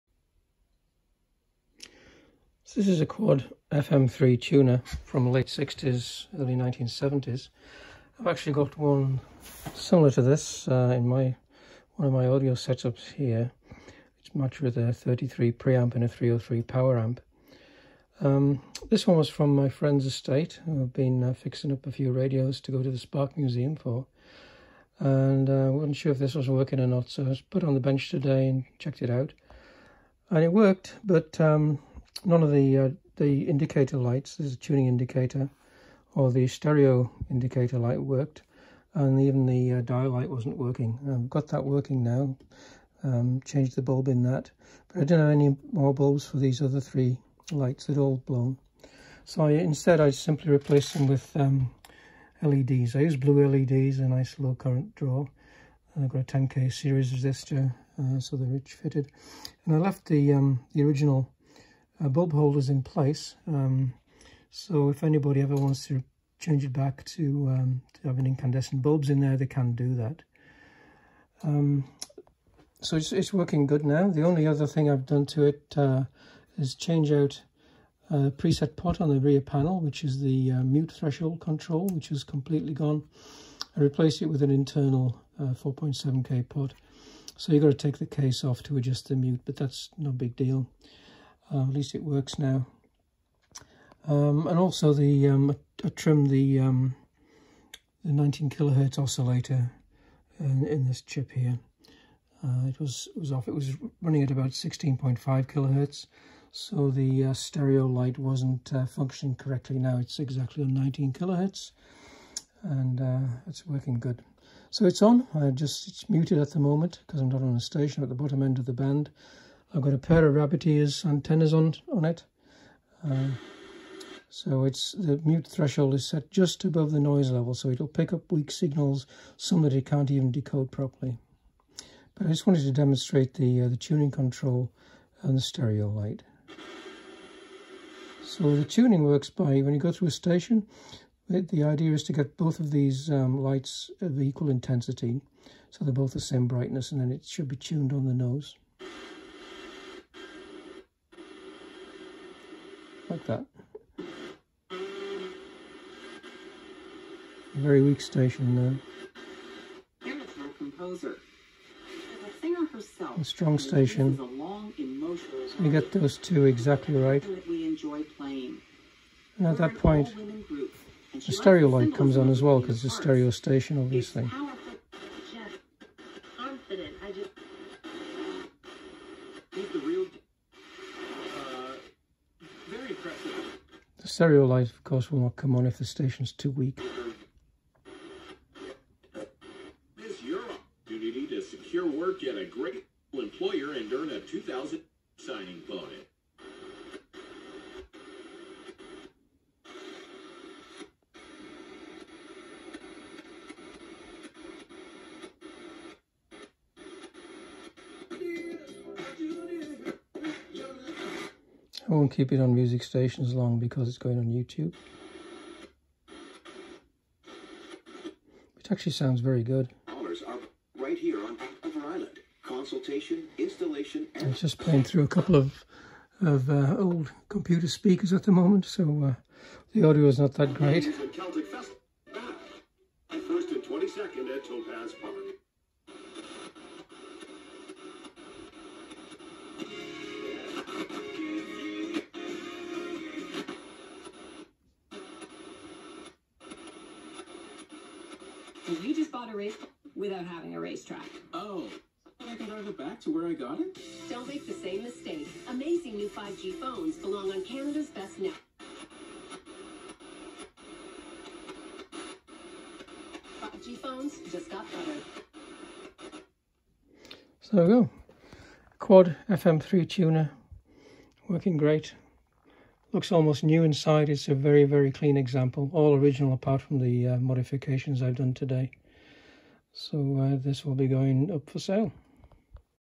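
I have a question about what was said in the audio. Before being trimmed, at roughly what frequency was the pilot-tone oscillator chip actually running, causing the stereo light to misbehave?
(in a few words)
16.5 kilohertz.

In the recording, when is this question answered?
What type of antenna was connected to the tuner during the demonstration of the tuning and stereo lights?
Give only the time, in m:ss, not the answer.
2:00.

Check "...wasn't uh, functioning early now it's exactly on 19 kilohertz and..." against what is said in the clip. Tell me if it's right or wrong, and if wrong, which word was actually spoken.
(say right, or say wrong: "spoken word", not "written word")
wrong: "correctly", not "early".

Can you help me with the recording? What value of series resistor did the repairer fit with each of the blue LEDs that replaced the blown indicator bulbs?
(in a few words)
10k.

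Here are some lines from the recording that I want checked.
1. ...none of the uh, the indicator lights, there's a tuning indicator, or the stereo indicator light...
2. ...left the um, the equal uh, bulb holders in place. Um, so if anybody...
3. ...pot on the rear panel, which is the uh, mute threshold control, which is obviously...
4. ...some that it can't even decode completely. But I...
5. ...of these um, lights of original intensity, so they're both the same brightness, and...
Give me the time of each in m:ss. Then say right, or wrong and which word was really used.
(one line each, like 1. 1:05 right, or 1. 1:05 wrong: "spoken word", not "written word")
1. 0:32 right
2. 0:59 wrong: "original", not "equal"
3. 1:18 wrong: "completely", not "obviously"
4. 2:09 wrong: "properly", not "completely"
5. 2:22 wrong: "equal", not "original".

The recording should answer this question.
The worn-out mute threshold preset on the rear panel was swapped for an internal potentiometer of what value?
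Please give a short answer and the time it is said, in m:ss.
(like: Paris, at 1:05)
4.7K, at 1:25.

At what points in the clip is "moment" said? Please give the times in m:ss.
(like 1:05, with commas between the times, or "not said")
1:56, 3:48.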